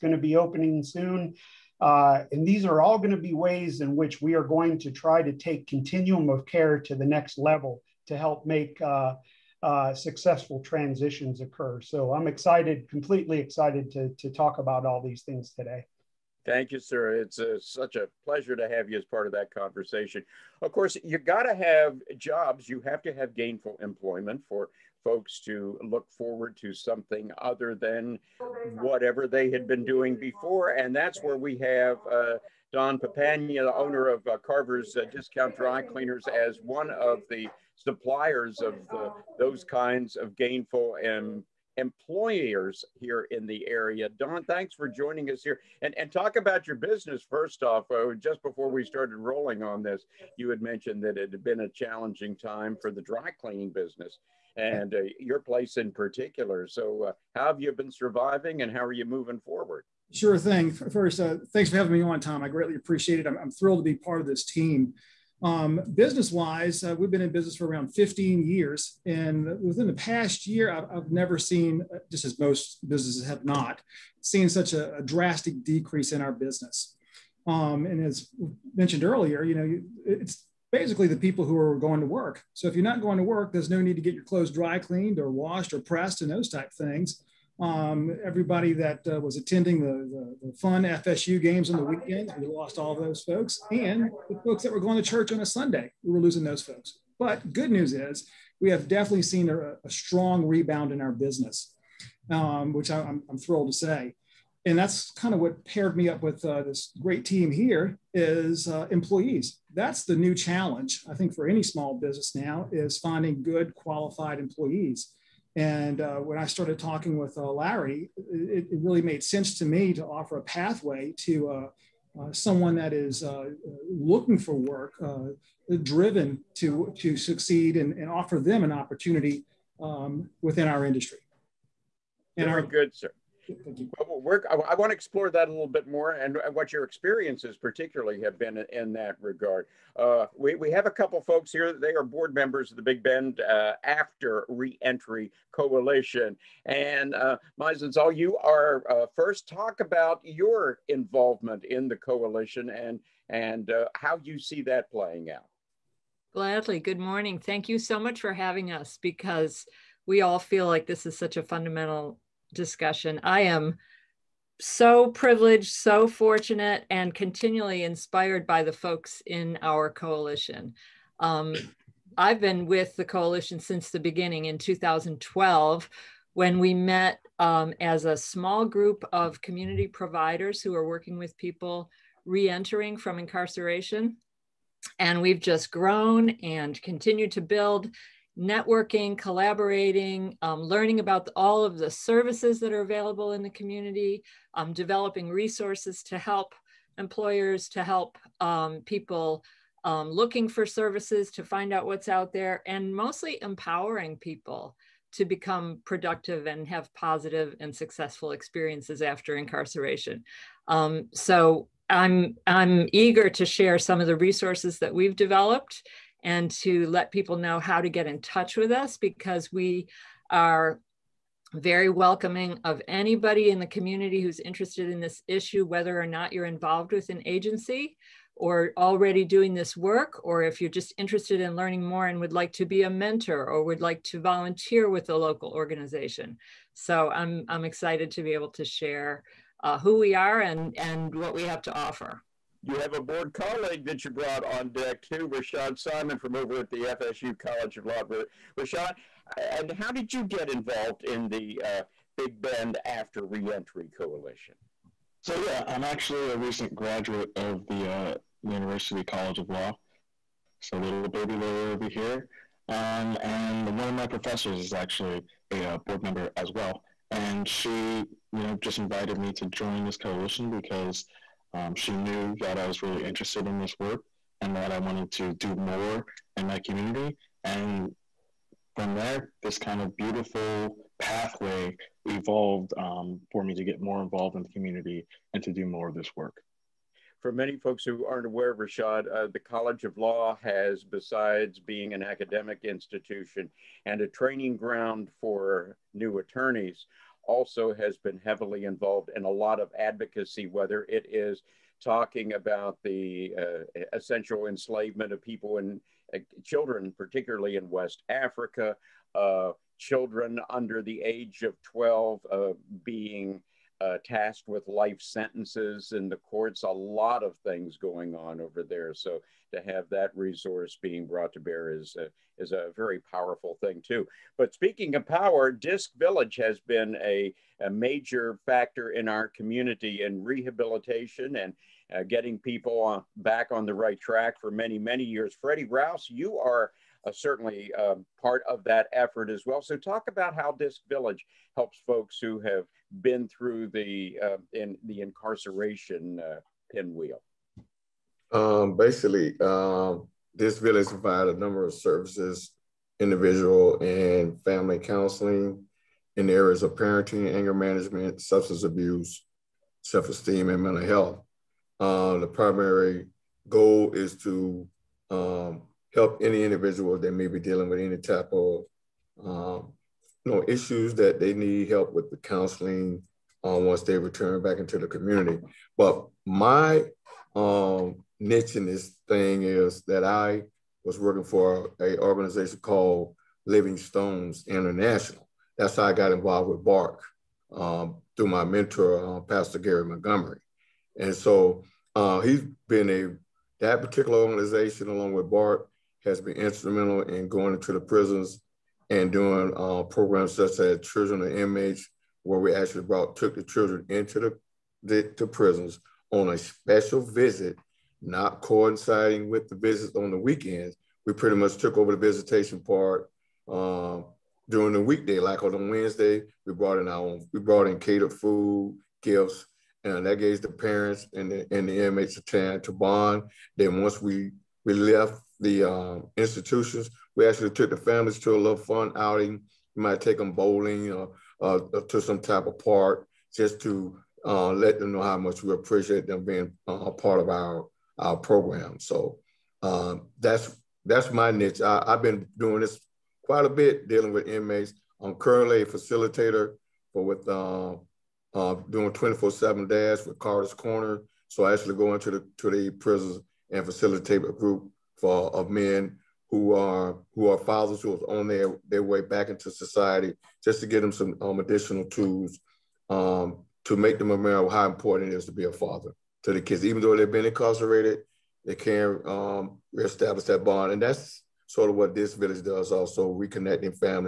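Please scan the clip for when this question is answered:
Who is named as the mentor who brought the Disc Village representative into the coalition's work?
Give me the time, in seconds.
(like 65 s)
389 s.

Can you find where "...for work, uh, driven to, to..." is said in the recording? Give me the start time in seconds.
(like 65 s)
124 s.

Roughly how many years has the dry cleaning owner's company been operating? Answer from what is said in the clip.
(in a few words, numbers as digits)
15 years.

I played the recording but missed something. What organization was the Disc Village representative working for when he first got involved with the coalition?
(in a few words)
Living Stones International.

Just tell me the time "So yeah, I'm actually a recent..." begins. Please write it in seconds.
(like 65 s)
255 s.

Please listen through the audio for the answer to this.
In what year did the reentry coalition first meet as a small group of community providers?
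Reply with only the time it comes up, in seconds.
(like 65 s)
174 s.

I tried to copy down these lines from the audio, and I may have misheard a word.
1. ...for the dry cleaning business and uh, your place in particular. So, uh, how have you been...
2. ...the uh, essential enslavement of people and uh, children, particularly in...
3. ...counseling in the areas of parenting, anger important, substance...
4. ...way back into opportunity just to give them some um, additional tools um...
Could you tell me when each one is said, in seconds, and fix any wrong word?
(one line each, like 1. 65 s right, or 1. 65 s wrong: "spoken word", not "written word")
1. 52 s right
2. 302 s right
3. 354 s wrong: "management", not "important"
4. 458 s wrong: "society", not "opportunity".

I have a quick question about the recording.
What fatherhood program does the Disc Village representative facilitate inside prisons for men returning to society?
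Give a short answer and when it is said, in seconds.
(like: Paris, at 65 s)
24/7 Dad, at 448 s.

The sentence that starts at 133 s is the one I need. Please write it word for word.
Well, I, want to explore that a little bit more and what your experiences particularly have been in that regard.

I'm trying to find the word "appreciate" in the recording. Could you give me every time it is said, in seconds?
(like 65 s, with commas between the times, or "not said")
62 s, 435 s.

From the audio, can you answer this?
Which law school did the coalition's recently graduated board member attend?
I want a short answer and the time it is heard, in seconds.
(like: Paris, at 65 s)
FSU College of Law, at 246 s.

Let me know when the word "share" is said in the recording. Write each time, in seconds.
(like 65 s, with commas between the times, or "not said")
213 s, 238 s.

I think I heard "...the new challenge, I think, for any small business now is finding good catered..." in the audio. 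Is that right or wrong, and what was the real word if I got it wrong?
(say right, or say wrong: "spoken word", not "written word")
wrong: "qualified", not "catered".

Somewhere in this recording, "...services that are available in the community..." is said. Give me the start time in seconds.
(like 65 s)
191 s.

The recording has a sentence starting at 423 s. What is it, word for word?
Then once we we left the um, institutions, we actually took the families to a little fun outing.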